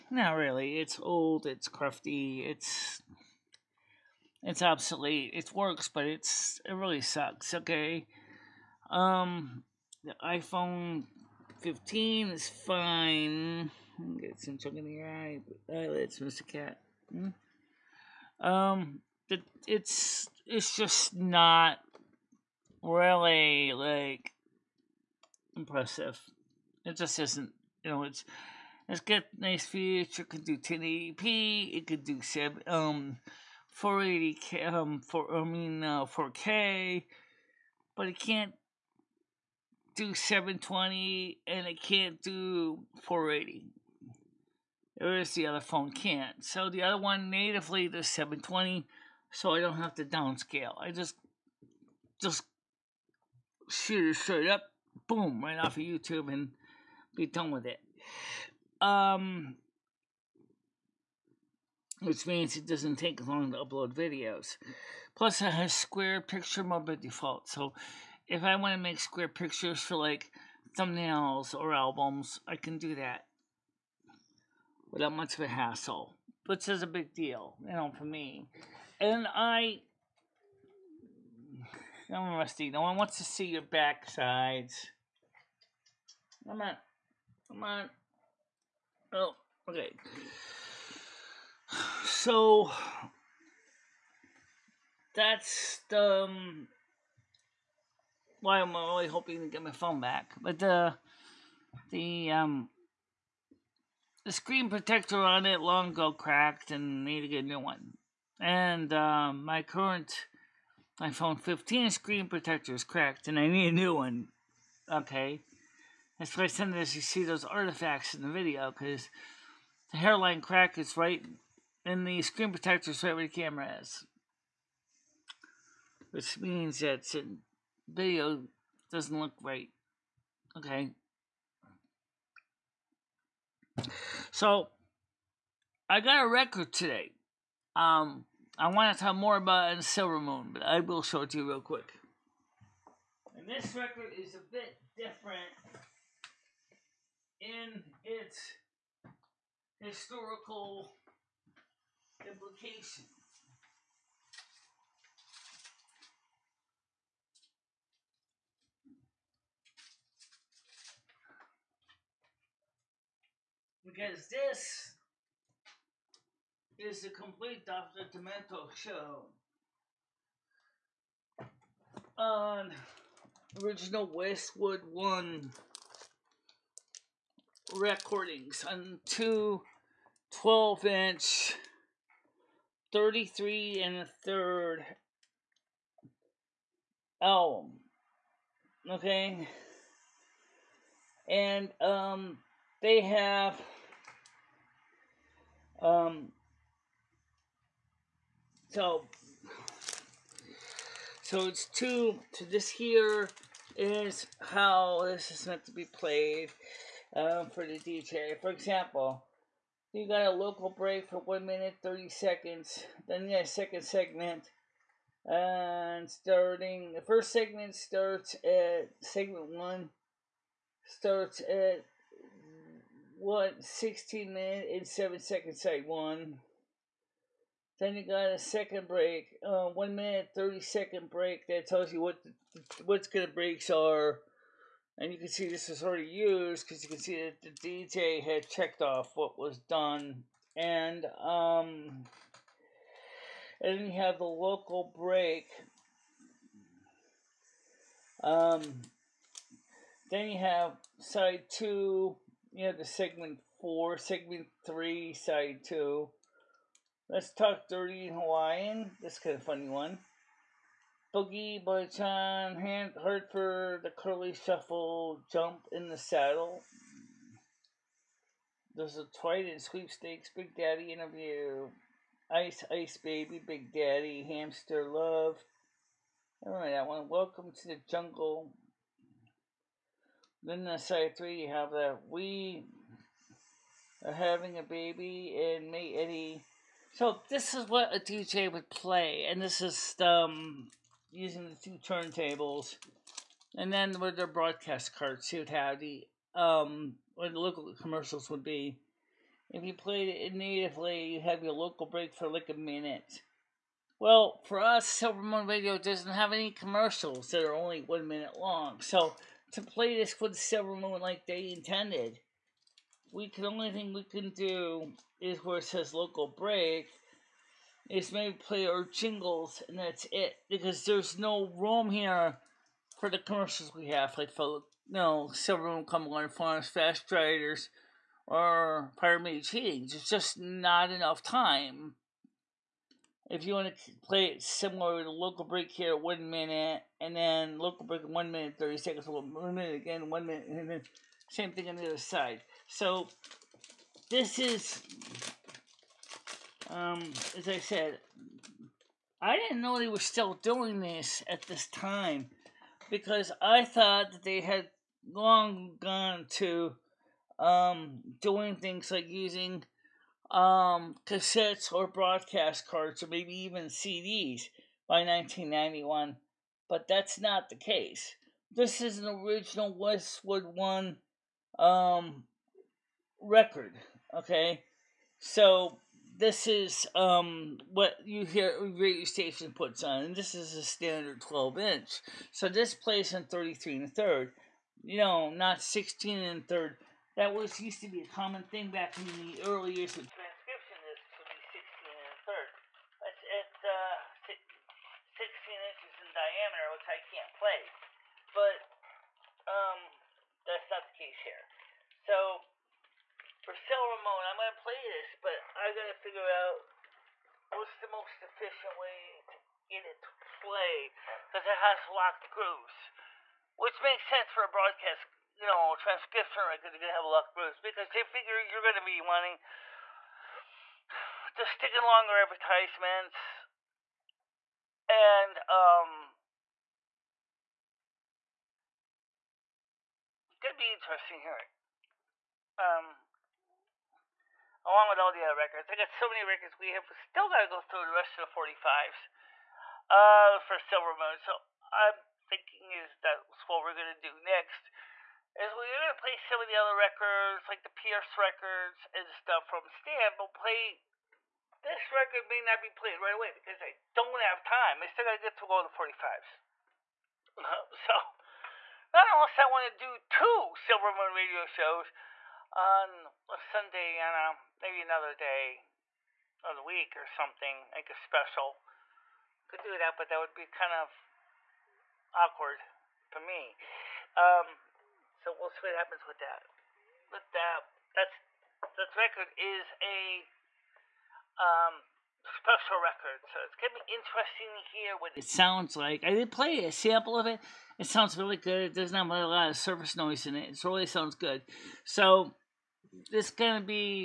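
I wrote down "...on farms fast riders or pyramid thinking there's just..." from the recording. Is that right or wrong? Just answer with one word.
wrong.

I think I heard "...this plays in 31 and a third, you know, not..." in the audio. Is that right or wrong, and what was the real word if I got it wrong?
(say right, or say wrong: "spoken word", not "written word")
wrong: "33", not "31".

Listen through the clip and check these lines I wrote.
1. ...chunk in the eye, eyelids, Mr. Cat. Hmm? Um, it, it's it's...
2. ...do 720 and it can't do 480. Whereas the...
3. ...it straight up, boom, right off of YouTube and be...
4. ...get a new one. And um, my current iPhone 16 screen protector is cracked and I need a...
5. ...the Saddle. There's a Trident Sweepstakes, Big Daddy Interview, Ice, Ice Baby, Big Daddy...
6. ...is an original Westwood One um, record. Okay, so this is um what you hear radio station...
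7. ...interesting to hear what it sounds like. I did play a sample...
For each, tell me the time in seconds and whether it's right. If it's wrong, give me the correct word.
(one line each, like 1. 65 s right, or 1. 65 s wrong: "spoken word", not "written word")
1. 14 s right
2. 39 s right
3. 54 s right
4. 107 s wrong: "15", not "16"
5. 265 s right
6. 368 s right
7. 483 s right.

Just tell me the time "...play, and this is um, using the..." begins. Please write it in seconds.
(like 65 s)
288 s.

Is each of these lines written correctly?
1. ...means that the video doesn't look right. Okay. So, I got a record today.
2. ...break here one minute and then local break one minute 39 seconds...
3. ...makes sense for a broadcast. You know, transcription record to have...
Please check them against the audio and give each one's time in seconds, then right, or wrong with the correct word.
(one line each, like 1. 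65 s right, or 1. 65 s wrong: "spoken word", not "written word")
1. 126 s right
2. 335 s wrong: "30", not "39"
3. 413 s right.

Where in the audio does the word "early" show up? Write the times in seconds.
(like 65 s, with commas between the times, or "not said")
389 s.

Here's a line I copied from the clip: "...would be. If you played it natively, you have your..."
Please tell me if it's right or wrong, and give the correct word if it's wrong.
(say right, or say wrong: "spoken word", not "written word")
right.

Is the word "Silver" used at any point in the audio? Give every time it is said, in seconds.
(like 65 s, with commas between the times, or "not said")
139 s, 304 s, 310 s, 403 s, 440 s, 460 s.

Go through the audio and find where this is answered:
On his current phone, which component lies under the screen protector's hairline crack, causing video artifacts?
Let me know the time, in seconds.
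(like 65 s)
123 s.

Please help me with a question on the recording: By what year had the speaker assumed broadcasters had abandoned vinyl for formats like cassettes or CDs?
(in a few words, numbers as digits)
1991.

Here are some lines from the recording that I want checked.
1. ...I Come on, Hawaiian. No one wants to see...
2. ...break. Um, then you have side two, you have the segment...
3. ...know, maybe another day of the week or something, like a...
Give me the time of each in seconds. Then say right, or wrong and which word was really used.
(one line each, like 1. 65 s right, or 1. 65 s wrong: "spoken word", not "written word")
1. 79 s wrong: "Rusty", not "Hawaiian"
2. 244 s right
3. 464 s right.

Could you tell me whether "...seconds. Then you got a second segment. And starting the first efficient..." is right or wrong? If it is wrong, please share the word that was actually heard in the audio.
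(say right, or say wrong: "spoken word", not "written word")
wrong: "segment", not "efficient".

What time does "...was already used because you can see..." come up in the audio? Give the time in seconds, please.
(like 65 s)
235 s.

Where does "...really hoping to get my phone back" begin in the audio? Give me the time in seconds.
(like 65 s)
98 s.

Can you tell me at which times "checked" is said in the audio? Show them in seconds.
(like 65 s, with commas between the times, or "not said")
238 s.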